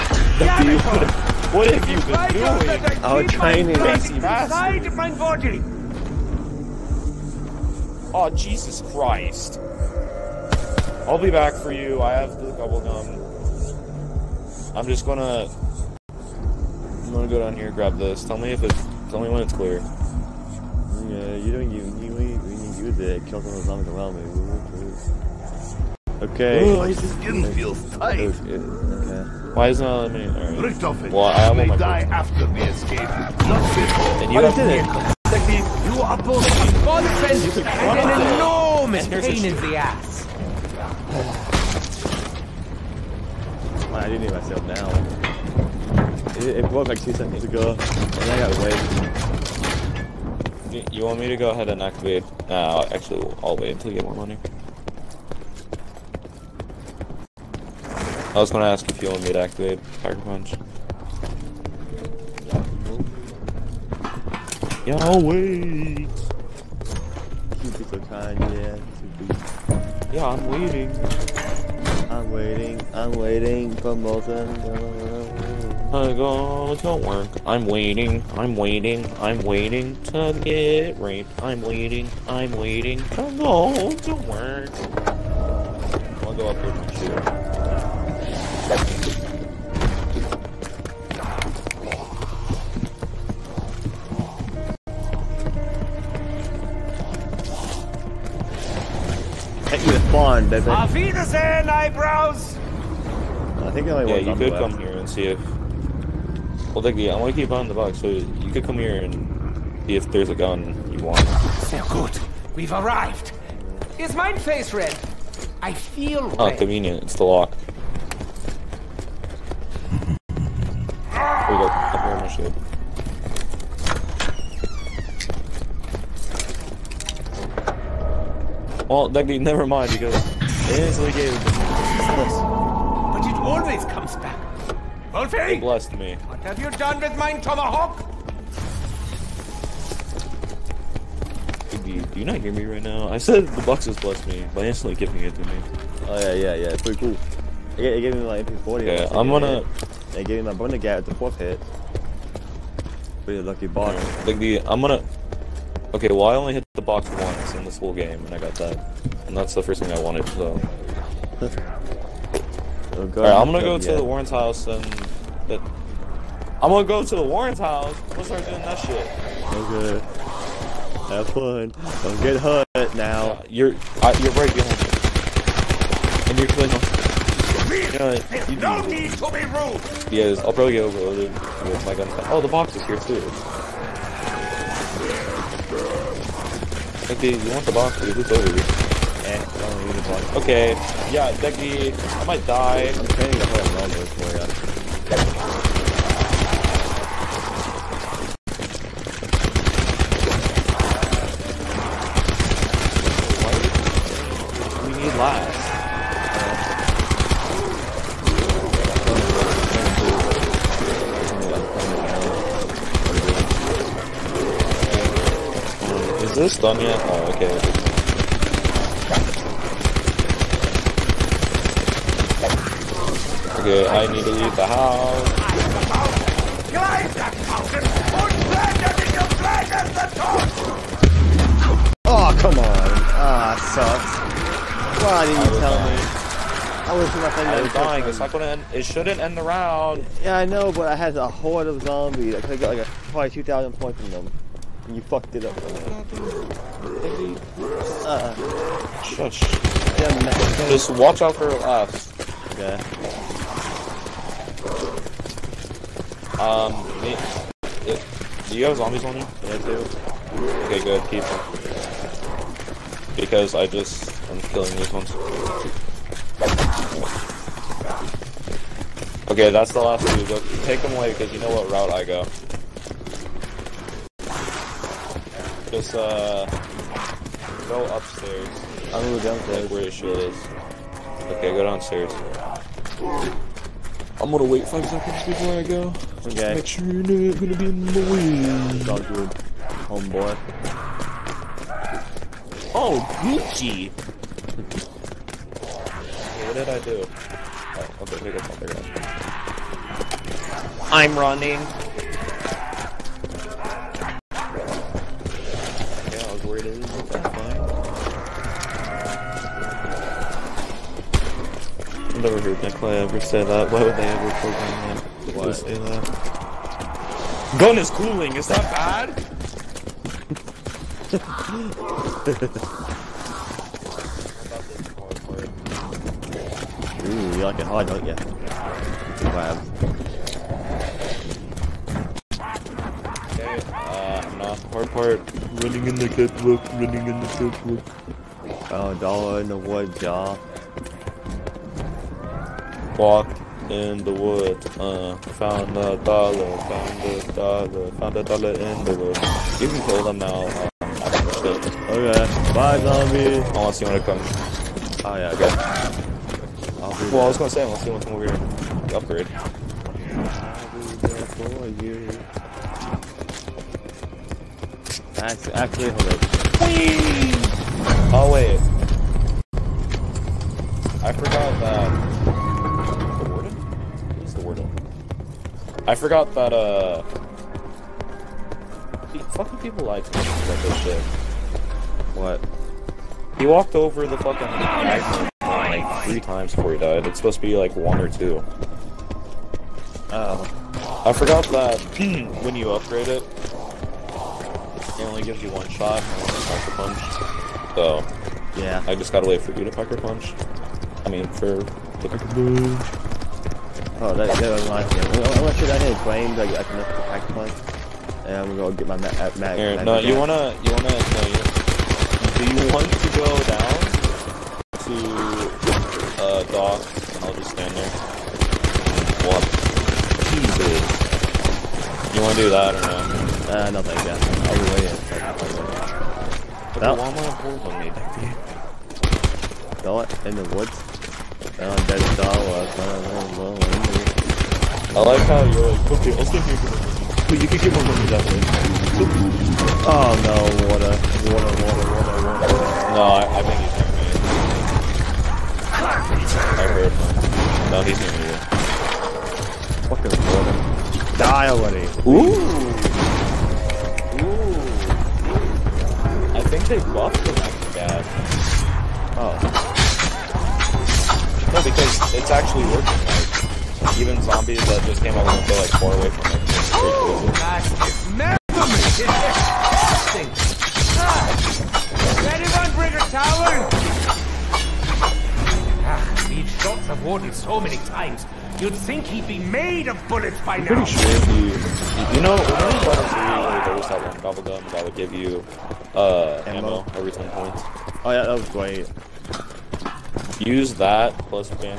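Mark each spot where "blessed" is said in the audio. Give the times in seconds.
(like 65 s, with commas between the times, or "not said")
135 s, 143 s.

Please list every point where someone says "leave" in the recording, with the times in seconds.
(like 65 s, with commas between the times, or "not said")
224 s.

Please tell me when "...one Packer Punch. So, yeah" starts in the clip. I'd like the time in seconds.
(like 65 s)
396 s.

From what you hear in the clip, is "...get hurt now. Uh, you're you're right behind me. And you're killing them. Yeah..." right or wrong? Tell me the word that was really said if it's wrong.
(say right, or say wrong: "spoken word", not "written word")
right.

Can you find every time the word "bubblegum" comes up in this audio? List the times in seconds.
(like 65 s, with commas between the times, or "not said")
12 s.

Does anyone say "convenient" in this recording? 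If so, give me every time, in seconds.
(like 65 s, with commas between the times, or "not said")
116 s.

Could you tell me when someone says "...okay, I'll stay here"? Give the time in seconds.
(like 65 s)
435 s.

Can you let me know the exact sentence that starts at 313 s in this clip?
Why would they ever program say that.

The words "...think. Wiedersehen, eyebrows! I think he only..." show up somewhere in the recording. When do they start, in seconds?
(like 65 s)
100 s.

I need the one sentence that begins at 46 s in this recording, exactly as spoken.
It, it broke like two seconds ago, and I got waved.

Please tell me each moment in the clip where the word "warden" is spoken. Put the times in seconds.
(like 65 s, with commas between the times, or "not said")
477 s.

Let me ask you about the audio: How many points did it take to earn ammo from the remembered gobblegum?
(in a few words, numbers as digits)
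10.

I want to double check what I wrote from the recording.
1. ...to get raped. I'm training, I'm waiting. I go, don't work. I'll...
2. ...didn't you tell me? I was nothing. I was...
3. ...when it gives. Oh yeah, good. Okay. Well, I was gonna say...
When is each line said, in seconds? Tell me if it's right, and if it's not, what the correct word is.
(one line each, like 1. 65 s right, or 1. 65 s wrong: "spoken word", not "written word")
1. 80 s wrong: "waiting", not "training"
2. 235 s right
3. 353 s wrong: "comes", not "gives".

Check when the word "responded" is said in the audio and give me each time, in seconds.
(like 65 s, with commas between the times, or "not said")
not said.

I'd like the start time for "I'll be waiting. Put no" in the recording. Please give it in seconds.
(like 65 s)
424 s.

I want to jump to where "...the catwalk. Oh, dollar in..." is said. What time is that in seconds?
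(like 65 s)
337 s.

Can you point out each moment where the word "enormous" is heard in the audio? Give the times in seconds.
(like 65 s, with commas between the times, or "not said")
38 s.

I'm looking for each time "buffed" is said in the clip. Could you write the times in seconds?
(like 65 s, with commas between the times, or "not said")
456 s.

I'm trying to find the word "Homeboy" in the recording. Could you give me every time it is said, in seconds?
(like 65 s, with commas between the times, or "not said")
289 s.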